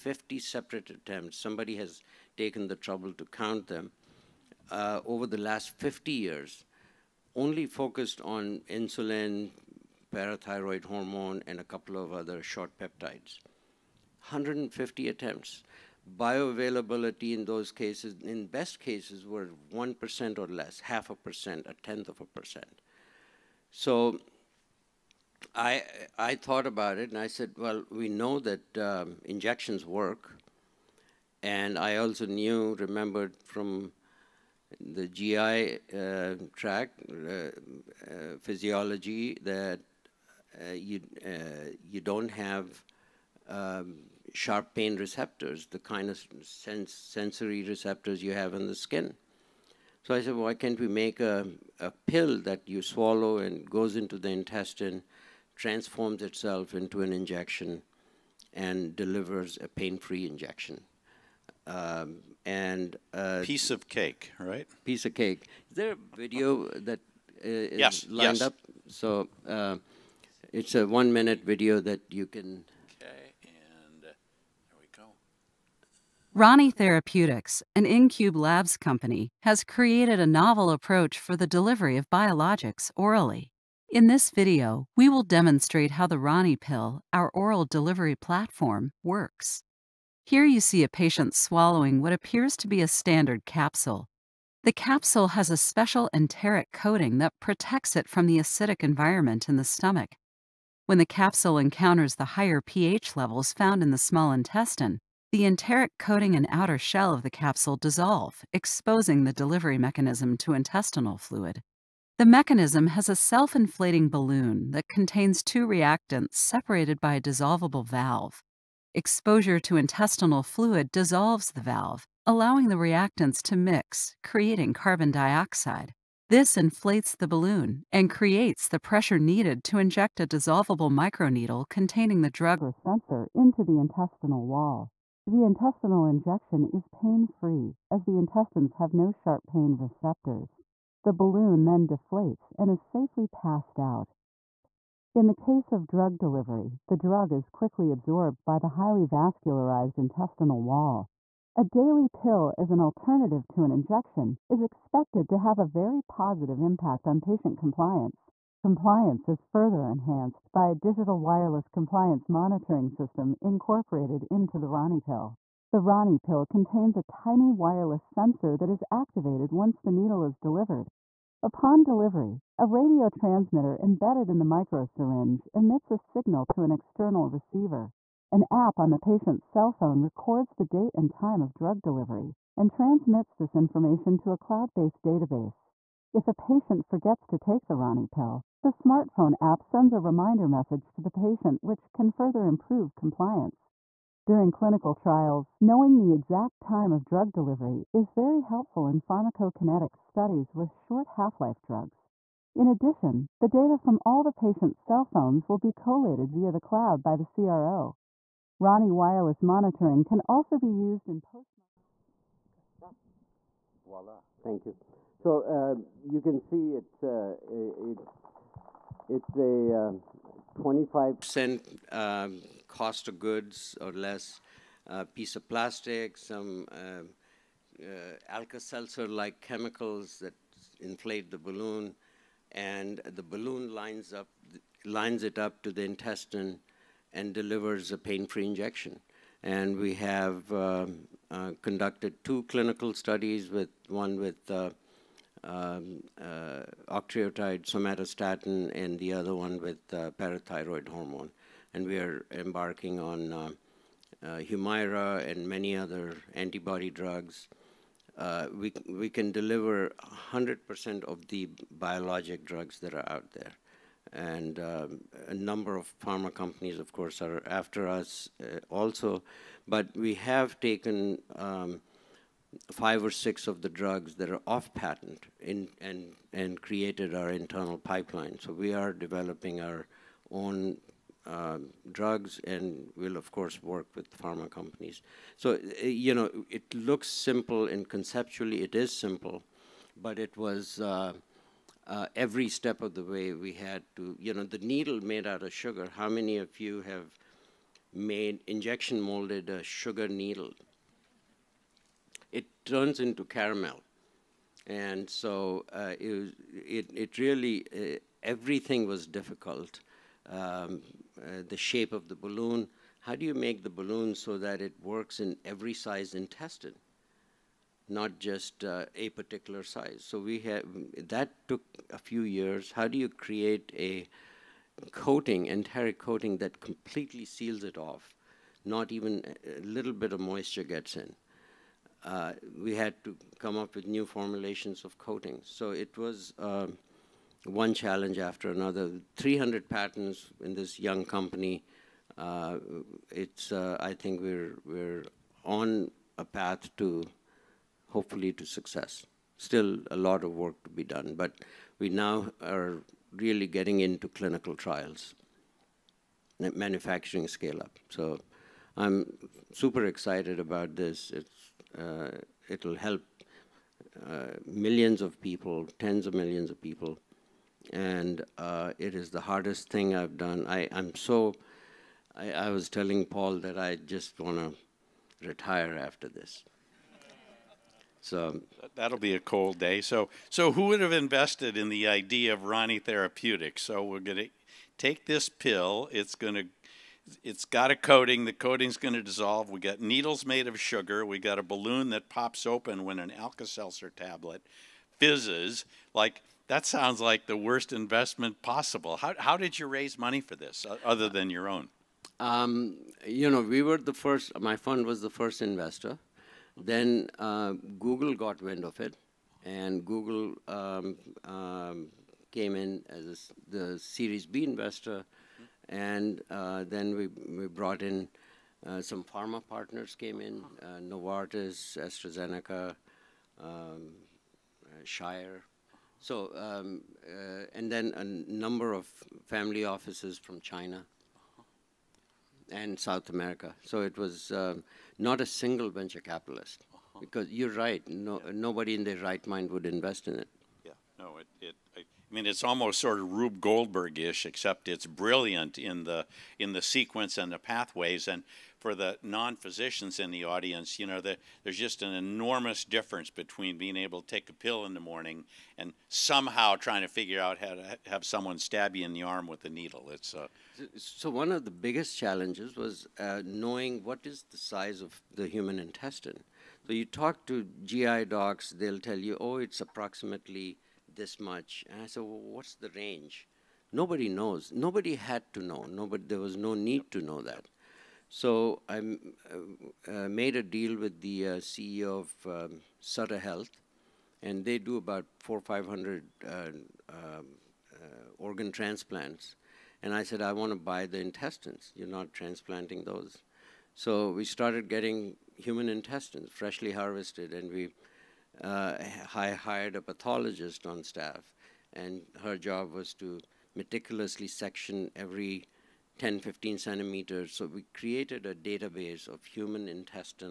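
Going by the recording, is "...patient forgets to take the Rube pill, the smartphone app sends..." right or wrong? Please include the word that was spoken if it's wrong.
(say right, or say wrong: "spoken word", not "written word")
wrong: "Rani", not "Rube".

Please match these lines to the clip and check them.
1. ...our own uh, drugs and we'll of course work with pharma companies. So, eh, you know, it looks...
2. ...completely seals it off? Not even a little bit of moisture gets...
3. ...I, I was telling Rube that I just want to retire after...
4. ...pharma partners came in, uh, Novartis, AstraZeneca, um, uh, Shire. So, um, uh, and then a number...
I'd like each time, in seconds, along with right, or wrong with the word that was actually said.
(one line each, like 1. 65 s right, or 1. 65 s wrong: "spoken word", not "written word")
1. 279 s right
2. 326 s right
3. 372 s wrong: "Paul", not "Rube"
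4. 419 s right.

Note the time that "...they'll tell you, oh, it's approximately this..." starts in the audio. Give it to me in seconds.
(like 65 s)
468 s.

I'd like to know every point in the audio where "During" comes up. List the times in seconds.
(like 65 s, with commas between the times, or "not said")
194 s.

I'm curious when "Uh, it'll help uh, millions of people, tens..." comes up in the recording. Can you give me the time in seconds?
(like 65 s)
361 s.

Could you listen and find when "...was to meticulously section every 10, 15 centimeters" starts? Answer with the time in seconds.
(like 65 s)
502 s.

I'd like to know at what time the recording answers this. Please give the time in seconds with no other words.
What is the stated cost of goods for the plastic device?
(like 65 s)
220 s.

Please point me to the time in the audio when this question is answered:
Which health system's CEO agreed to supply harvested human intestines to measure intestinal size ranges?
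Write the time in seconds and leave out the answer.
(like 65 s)
482 s.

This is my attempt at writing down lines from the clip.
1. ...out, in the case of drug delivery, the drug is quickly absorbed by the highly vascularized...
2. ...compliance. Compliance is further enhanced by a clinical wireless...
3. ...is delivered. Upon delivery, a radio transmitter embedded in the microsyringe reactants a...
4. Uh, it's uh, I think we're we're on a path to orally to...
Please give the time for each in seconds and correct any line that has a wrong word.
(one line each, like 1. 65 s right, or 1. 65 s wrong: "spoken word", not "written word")
1. 143 s right
2. 157 s wrong: "digital", not "clinical"
3. 170 s wrong: "emits", not "reactants"
4. 342 s wrong: "hopefully", not "orally".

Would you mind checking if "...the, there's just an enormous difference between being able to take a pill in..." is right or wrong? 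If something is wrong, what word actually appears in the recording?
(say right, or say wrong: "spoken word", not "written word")
right.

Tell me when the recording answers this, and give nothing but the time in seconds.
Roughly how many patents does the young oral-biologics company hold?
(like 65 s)
339 s.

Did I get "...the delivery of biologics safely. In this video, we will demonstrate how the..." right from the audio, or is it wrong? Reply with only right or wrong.
wrong.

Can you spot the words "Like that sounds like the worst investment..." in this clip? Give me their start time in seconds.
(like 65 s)
395 s.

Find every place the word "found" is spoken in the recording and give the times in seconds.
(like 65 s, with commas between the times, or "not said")
103 s.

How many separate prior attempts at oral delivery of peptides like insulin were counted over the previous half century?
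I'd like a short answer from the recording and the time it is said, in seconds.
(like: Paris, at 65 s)
150, at 14 s.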